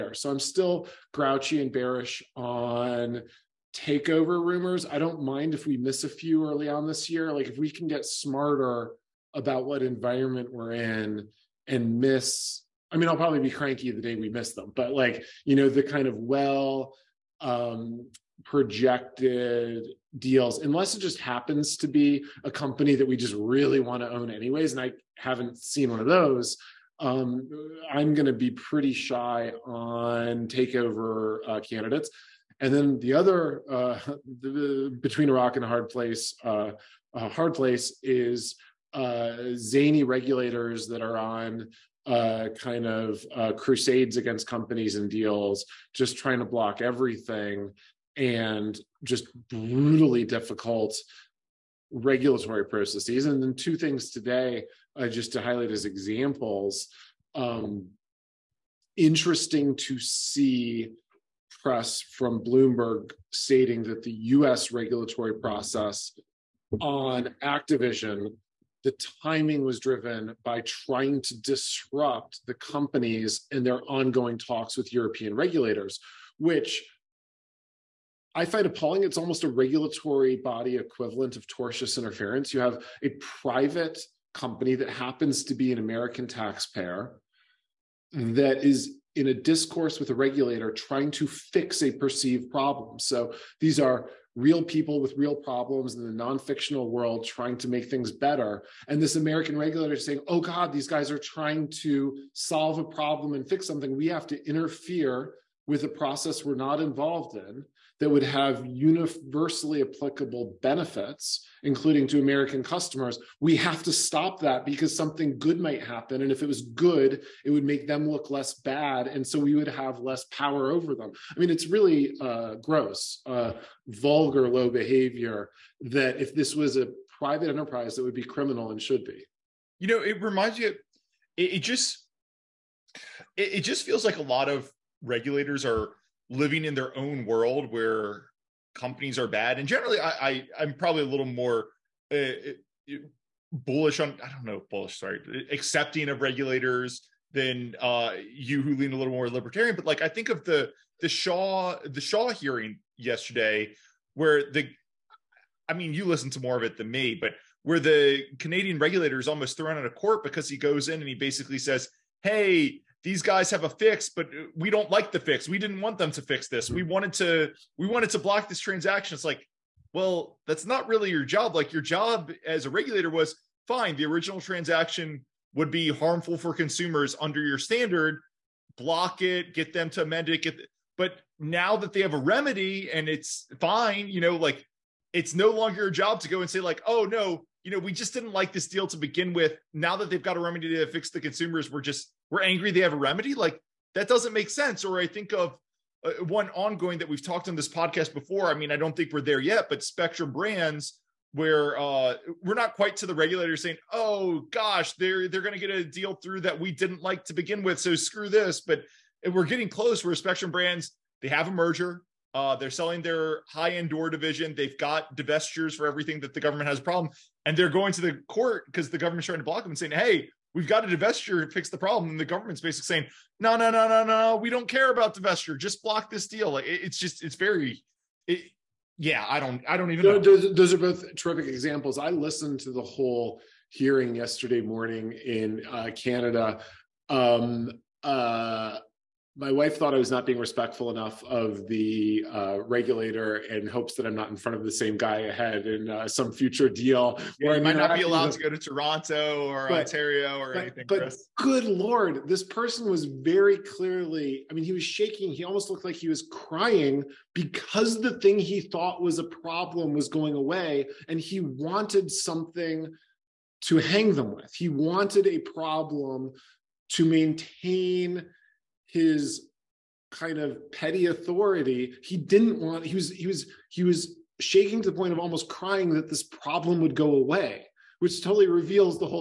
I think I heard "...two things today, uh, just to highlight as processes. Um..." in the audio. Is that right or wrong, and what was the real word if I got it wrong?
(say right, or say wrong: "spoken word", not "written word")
wrong: "examples", not "processes".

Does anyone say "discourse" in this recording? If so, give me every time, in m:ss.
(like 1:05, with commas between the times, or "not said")
1:29.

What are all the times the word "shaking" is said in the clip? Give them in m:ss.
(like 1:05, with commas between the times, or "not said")
4:14, 4:34.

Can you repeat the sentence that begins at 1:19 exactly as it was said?
It's almost a regulatory body equivalent of tortious interference.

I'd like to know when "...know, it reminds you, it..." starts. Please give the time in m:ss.
2:09.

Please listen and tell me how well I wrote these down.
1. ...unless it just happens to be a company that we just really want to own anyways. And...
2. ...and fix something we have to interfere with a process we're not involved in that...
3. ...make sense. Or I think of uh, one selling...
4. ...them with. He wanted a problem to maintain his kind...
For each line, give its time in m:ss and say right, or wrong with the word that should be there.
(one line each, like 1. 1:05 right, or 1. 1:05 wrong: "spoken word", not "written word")
1. 0:20 right
2. 1:43 right
3. 3:14 wrong: "ongoing", not "selling"
4. 4:24 right.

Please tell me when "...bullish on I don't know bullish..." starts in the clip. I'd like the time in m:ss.
2:23.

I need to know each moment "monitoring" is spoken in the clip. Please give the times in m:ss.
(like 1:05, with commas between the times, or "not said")
not said.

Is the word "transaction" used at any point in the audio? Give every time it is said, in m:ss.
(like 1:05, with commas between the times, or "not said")
2:48, 2:54.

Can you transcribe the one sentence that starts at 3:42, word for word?
And the government's basically saying, no, no, no, no, no, we don't care about divestiture.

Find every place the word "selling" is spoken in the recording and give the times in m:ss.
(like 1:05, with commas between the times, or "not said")
3:32.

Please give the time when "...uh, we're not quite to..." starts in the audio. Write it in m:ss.
3:21.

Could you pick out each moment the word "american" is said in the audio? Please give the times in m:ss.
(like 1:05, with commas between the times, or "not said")
1:25, 1:39, 1:52.